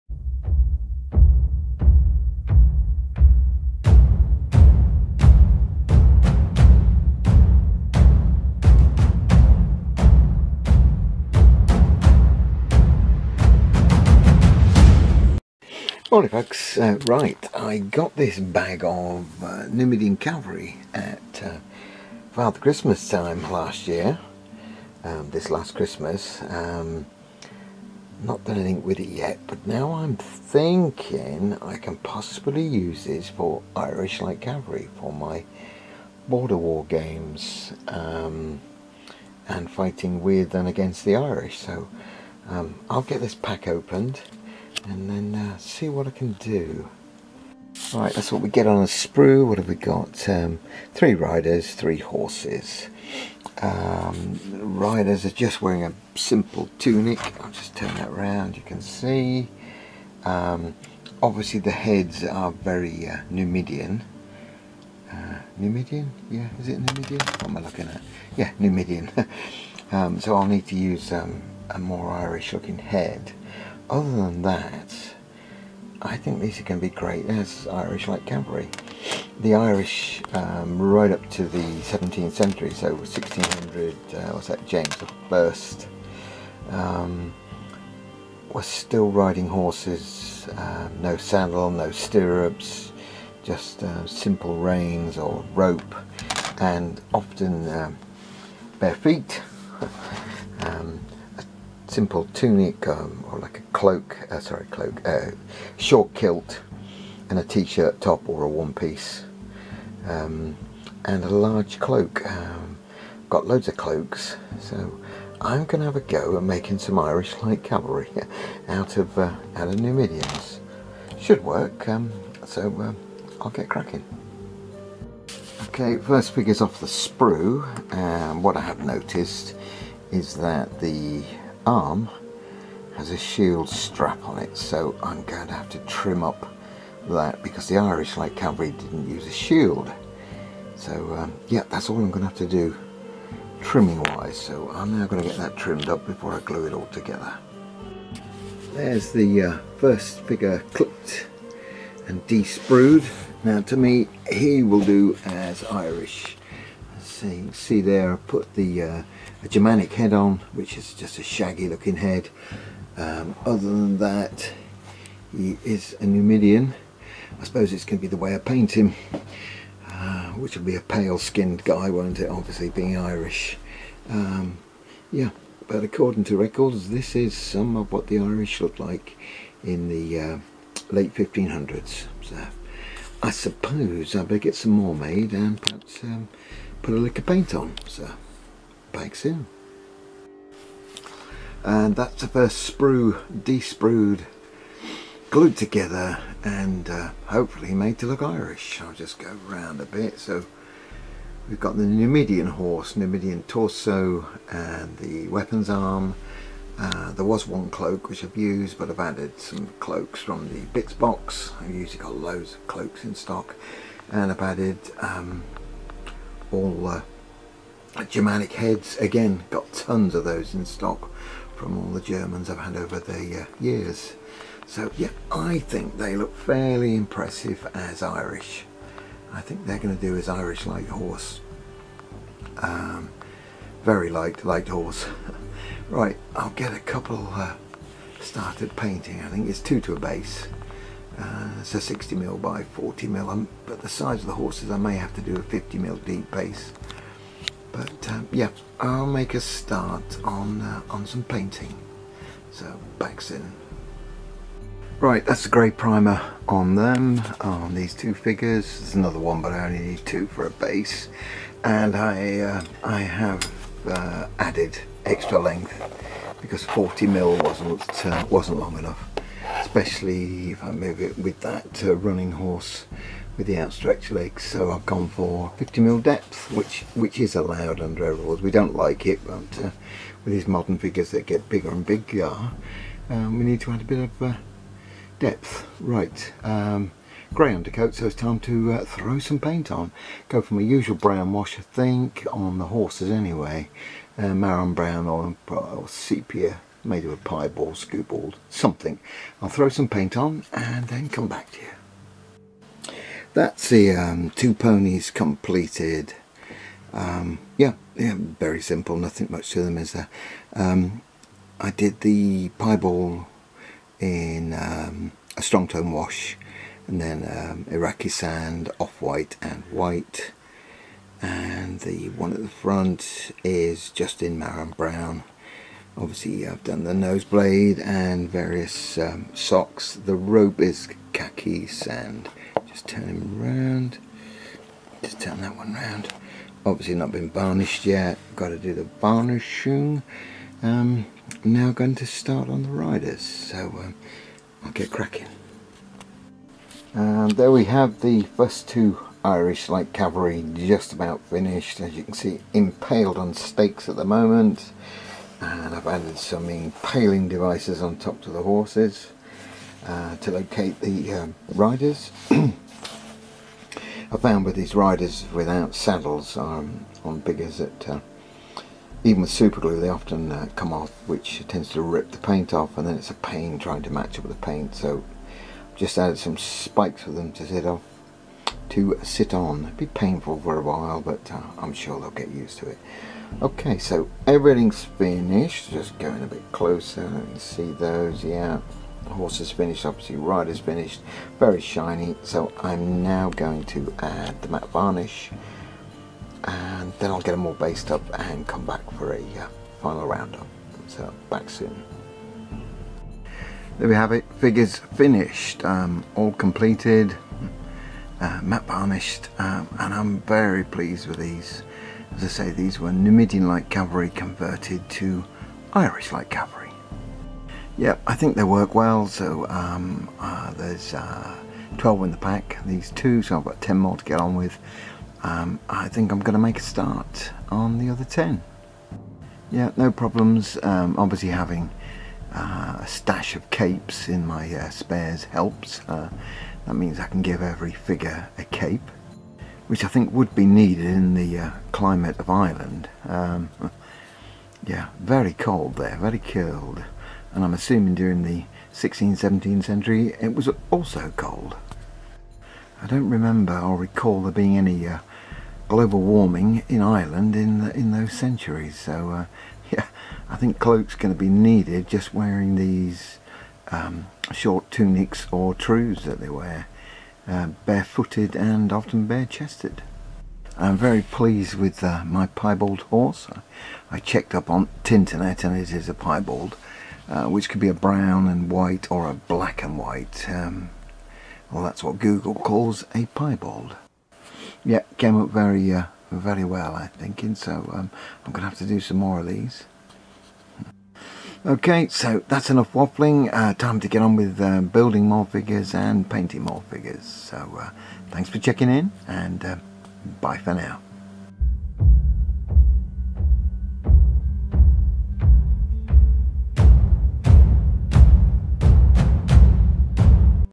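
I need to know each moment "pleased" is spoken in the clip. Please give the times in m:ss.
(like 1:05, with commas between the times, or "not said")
6:50, 7:51.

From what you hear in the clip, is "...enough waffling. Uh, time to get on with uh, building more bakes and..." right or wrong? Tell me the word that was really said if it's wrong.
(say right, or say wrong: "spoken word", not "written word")
wrong: "figures", not "bakes".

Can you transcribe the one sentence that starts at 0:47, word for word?
Right, that's what we get on a sprue.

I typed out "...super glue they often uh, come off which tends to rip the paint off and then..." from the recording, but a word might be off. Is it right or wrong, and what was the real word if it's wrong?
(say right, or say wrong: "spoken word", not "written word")
right.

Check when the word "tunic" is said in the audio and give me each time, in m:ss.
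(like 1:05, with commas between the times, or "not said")
0:56, 1:42, 7:44.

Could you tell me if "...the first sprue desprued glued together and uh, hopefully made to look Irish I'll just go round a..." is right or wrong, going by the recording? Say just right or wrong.
right.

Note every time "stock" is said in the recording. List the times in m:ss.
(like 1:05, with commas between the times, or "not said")
3:33, 3:40.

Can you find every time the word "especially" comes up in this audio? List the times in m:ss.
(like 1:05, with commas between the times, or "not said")
4:29.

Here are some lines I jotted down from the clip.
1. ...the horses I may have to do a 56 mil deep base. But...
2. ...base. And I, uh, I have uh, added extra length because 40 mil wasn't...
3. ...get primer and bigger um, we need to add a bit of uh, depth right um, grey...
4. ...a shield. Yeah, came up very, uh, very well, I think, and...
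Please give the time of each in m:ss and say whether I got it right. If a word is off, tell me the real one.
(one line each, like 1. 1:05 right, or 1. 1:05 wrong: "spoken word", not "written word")
1. 4:04 wrong: "50", not "56"
2. 4:20 right
3. 4:41 wrong: "bigger", not "primer"
4. 8:02 wrong: "piebald", not "shield".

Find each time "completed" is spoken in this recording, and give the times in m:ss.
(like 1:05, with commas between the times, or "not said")
5:05, 6:46.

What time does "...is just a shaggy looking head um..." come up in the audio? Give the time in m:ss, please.
2:40.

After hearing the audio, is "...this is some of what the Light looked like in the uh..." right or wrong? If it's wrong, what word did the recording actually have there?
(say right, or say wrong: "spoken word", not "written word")
wrong: "Irish", not "Light".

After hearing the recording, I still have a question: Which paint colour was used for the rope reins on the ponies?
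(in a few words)
khaki sand.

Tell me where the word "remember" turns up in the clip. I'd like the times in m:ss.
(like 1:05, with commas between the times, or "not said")
7:33.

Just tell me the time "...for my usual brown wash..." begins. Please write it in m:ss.
4:50.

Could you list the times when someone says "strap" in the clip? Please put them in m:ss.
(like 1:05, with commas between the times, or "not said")
2:13.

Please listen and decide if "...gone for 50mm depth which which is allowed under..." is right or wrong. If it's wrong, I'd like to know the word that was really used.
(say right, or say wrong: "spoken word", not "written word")
right.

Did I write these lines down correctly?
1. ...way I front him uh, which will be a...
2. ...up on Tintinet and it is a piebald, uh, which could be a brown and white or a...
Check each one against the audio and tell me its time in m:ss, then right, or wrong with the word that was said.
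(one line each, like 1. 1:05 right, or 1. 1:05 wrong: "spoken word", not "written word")
1. 2:48 wrong: "paint", not "front"
2. 7:54 right.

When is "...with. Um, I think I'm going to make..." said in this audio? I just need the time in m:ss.
7:04.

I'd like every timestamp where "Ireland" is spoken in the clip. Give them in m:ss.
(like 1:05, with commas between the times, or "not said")
7:22, 7:36.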